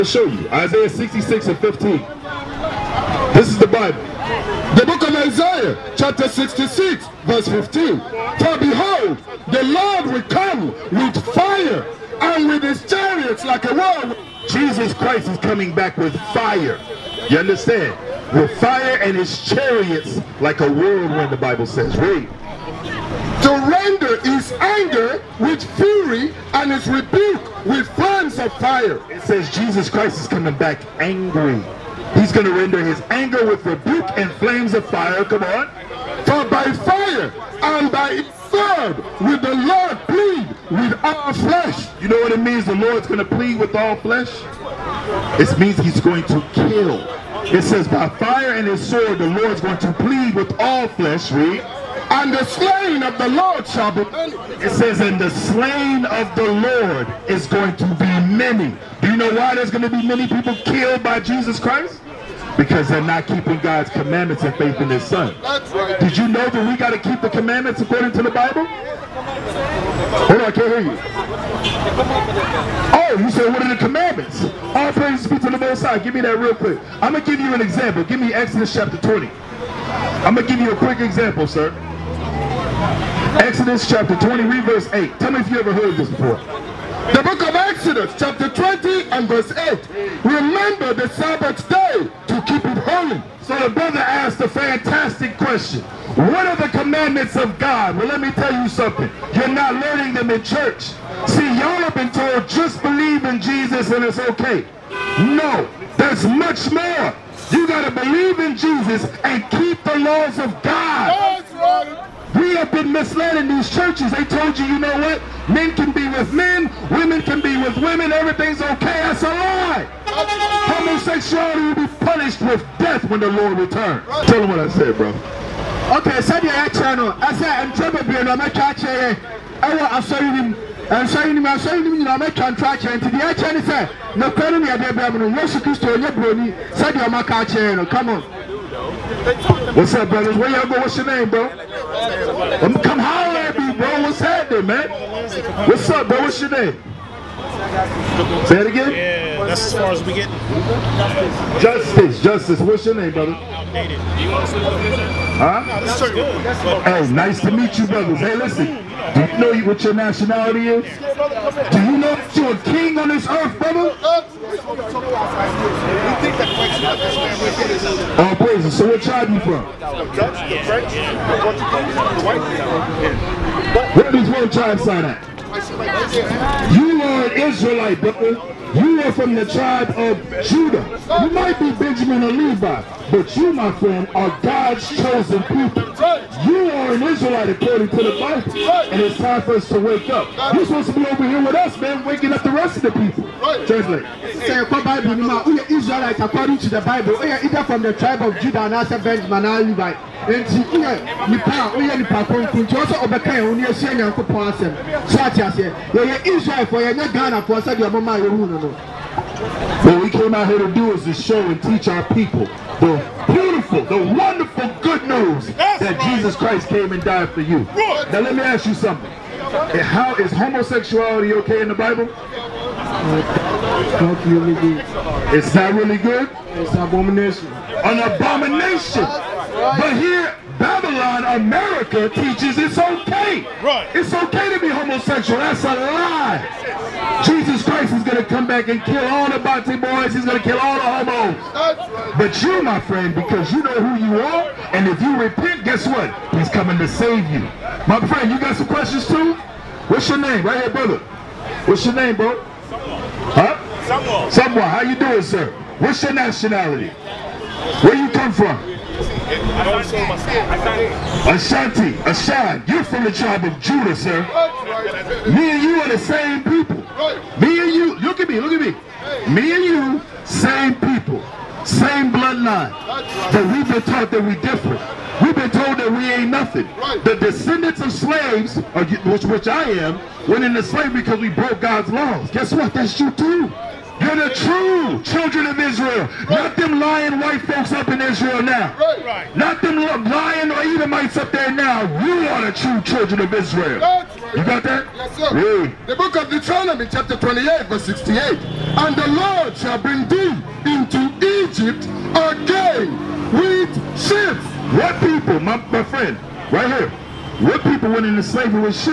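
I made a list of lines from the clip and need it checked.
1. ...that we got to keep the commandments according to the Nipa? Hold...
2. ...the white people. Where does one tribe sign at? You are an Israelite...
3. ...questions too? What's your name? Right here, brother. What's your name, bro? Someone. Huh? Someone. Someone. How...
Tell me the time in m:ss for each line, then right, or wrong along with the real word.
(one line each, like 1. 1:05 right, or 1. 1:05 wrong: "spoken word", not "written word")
1. 1:06 wrong: "Bible", not "Nipa"
2. 2:52 right
3. 4:08 right.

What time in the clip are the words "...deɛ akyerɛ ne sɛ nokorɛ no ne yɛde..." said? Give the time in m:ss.
2:13.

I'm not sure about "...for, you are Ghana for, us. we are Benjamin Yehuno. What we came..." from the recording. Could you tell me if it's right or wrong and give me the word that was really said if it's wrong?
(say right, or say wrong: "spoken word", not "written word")
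wrong: "Mama", not "Benjamin".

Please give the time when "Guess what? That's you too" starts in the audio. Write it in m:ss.
4:42.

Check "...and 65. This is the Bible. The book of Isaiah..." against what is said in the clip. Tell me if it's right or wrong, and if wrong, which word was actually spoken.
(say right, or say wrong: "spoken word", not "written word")
wrong: "15", not "65".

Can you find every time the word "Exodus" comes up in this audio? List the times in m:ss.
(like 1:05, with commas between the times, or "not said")
1:18, 1:23, 1:27.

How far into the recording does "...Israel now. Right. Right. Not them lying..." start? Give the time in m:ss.
4:48.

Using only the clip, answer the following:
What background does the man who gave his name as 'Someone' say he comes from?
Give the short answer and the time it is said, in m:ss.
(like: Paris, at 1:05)
Ashanti, at 4:21.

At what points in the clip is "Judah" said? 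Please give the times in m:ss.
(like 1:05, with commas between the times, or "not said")
3:00, 3:18, 4:23.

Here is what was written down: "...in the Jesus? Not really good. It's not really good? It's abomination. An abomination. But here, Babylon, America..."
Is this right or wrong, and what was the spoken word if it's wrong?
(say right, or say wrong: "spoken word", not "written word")
wrong: "Bible", not "Jesus".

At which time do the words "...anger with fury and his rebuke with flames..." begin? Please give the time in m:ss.
0:24.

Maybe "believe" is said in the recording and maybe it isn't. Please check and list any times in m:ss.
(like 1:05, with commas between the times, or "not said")
1:42, 1:47.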